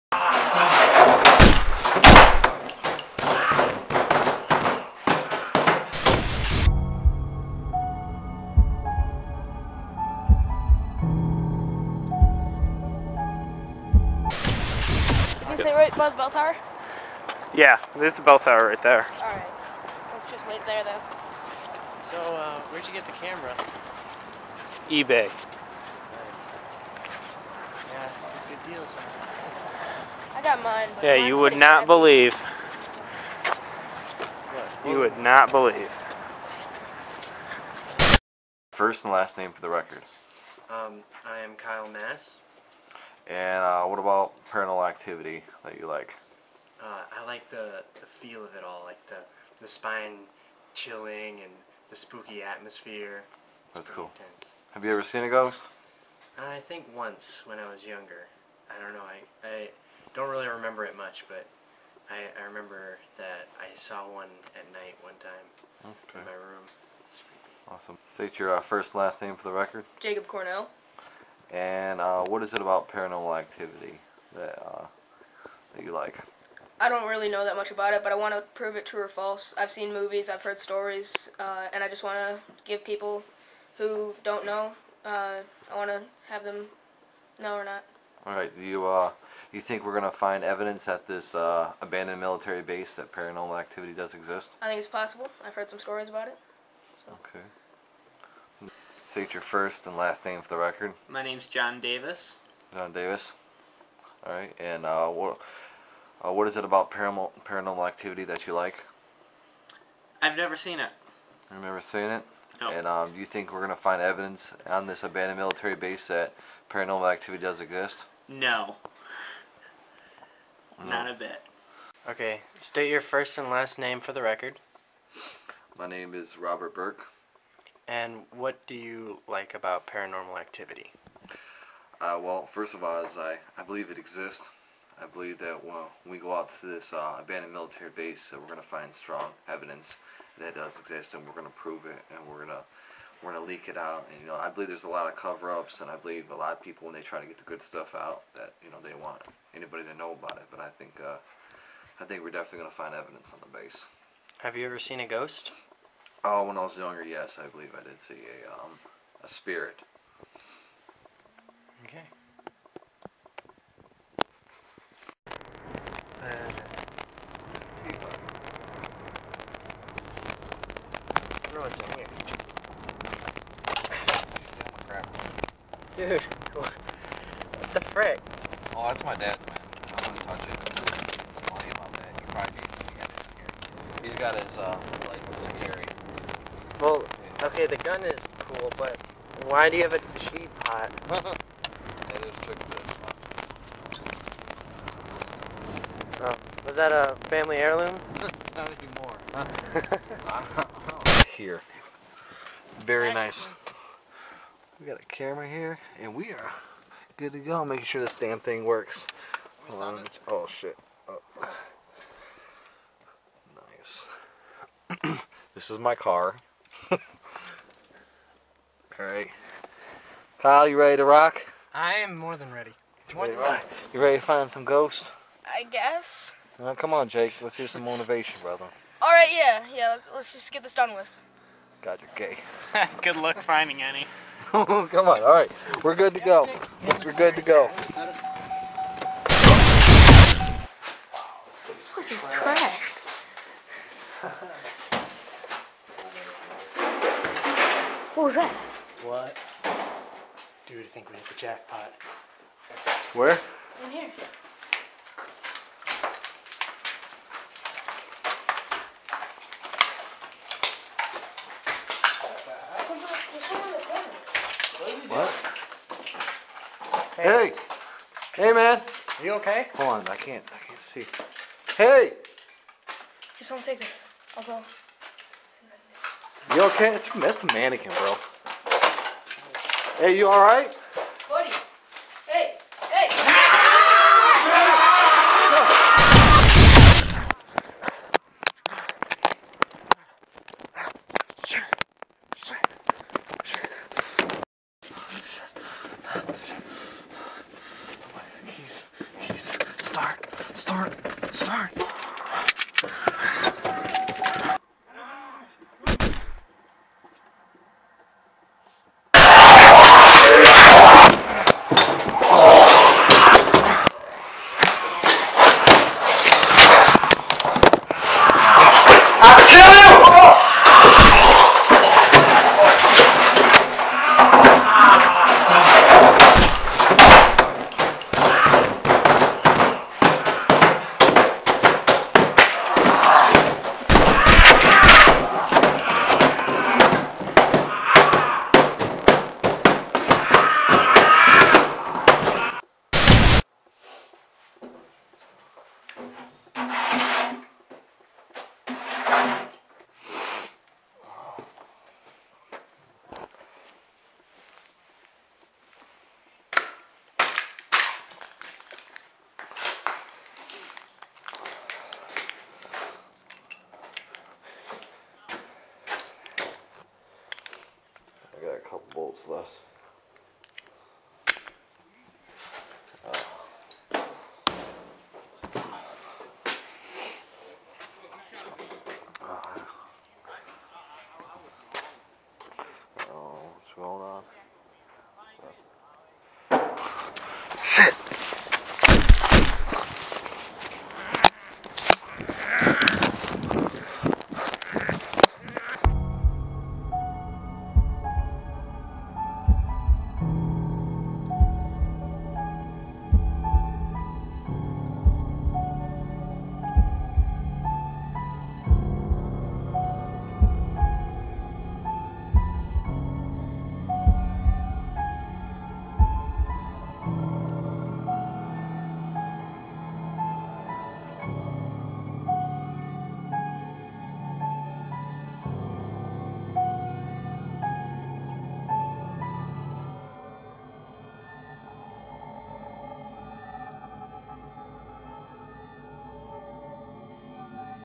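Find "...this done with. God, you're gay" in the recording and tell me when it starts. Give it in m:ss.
3:50.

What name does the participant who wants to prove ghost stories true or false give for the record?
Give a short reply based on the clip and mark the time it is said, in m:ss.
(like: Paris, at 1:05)
Jacob Cornell, at 1:09.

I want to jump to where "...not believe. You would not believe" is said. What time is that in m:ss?
0:31.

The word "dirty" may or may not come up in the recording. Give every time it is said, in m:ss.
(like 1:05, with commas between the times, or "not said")
not said.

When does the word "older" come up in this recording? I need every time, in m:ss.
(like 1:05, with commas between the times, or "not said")
not said.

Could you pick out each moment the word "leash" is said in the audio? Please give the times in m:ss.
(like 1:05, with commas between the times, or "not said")
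not said.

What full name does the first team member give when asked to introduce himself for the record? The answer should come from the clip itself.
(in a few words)
Kyle Mass.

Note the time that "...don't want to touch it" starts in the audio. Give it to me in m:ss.
3:00.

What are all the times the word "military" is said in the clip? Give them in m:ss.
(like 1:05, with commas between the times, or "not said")
1:32, 1:55, 2:17.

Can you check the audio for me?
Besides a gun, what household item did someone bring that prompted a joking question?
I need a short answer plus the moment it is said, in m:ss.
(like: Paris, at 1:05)
a teapot, at 3:10.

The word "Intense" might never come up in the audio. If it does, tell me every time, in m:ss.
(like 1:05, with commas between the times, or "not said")
0:54.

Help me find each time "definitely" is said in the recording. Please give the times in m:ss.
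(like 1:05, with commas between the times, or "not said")
2:32.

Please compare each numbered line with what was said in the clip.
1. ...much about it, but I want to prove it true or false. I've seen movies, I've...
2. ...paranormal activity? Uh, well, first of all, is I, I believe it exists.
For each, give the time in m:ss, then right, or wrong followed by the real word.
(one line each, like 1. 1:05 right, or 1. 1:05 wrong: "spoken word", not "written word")
1. 1:17 right
2. 2:09 right.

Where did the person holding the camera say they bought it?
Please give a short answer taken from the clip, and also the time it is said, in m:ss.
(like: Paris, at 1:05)
eBay, at 0:24.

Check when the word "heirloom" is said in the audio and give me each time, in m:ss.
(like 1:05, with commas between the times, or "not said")
3:17.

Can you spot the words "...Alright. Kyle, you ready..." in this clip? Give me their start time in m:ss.
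3:38.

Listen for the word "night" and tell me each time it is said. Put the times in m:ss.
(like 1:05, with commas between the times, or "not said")
1:04.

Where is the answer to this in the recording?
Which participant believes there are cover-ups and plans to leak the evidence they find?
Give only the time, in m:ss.
2:06.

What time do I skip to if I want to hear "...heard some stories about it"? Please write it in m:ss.
1:35.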